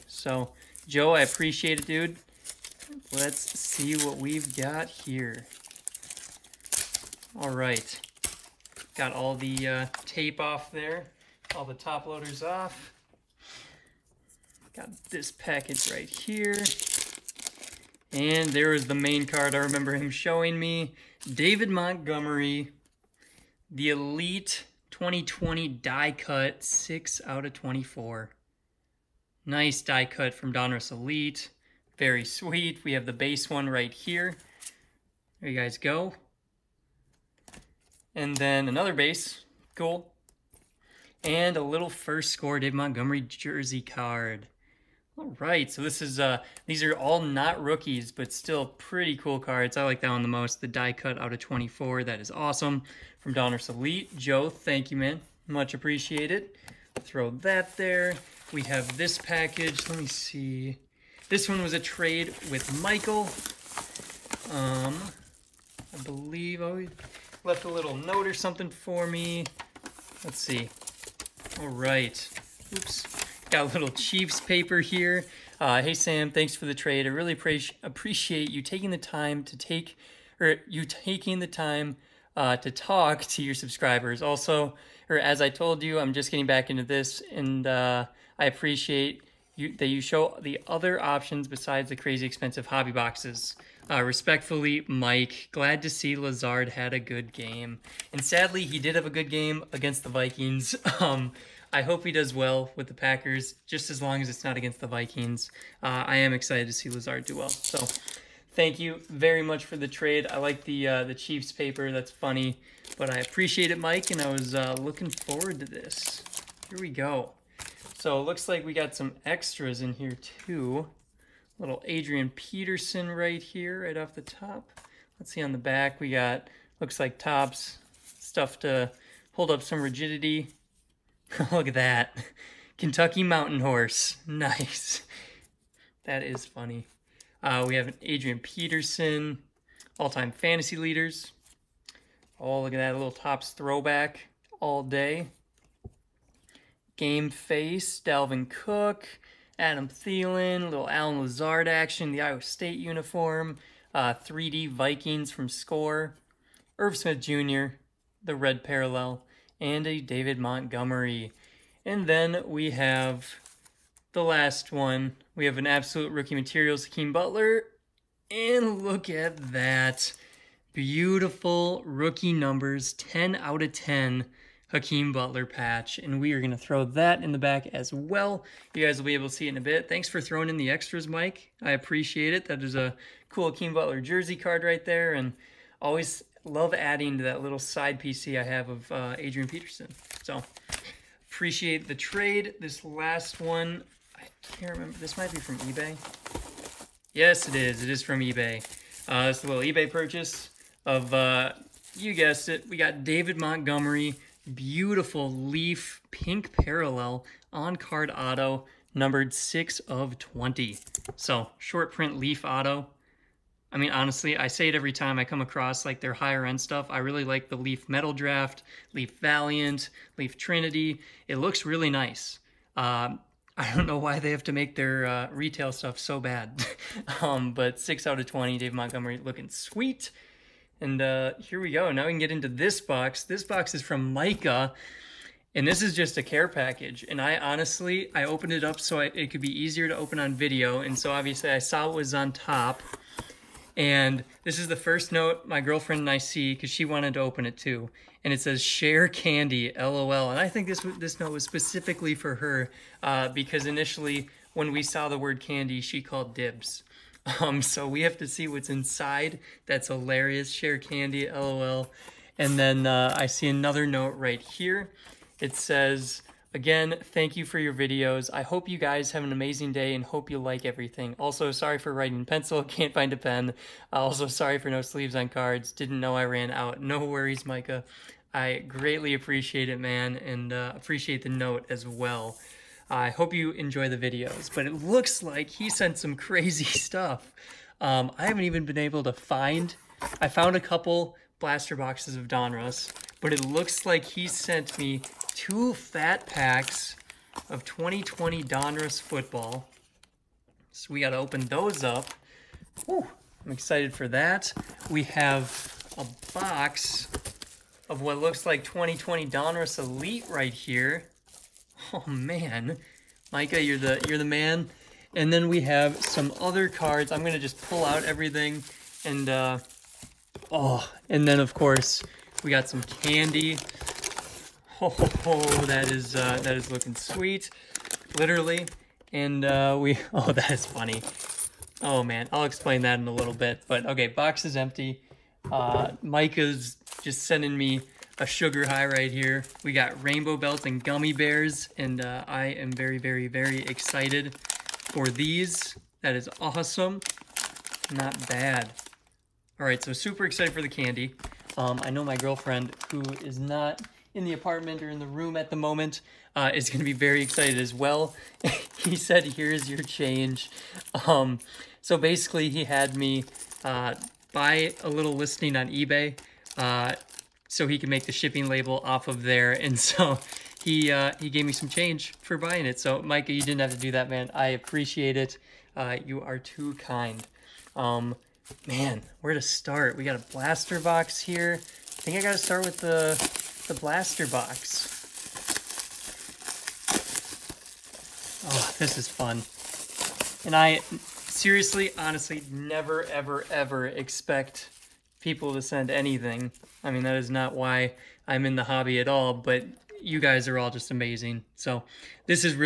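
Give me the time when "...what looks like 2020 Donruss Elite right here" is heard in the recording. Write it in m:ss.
5:08.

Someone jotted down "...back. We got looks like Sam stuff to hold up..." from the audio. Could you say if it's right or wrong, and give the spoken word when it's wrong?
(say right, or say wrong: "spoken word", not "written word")
wrong: "Topps", not "Sam".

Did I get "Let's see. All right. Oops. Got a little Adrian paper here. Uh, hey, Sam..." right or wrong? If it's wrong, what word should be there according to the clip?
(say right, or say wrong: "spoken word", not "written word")
wrong: "Chiefs", not "Adrian".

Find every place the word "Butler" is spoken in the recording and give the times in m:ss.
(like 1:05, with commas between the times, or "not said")
2:47, 2:55, 3:03.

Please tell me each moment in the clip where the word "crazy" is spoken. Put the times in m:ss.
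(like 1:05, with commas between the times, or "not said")
1:31, 4:46.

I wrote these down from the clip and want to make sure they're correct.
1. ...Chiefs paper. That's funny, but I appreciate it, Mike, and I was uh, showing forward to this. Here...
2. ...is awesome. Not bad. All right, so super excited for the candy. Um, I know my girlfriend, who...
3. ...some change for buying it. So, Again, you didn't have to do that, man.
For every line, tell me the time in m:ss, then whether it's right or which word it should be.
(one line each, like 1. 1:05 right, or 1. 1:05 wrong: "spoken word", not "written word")
1. 1:51 wrong: "looking", not "showing"
2. 5:46 right
3. 6:11 wrong: "Micah", not "Again".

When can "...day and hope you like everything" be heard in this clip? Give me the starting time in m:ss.
4:29.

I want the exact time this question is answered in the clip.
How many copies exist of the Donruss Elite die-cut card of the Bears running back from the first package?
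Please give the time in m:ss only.
0:26.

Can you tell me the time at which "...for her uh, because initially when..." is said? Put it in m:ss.
4:12.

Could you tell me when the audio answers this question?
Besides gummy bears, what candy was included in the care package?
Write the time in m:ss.
5:40.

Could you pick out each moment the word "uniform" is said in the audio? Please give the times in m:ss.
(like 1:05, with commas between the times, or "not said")
2:32.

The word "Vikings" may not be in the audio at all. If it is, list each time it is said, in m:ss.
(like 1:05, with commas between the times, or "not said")
1:40, 1:44, 2:34.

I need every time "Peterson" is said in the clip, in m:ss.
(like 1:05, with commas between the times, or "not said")
2:02, 2:18, 3:09.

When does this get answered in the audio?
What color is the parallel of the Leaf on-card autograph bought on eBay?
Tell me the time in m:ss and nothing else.
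3:26.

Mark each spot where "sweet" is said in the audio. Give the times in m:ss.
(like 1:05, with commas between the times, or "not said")
0:32, 3:49, 5:26.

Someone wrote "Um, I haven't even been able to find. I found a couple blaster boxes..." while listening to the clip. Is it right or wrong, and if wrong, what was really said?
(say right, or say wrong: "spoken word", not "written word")
right.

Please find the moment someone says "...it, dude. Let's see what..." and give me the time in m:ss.
0:01.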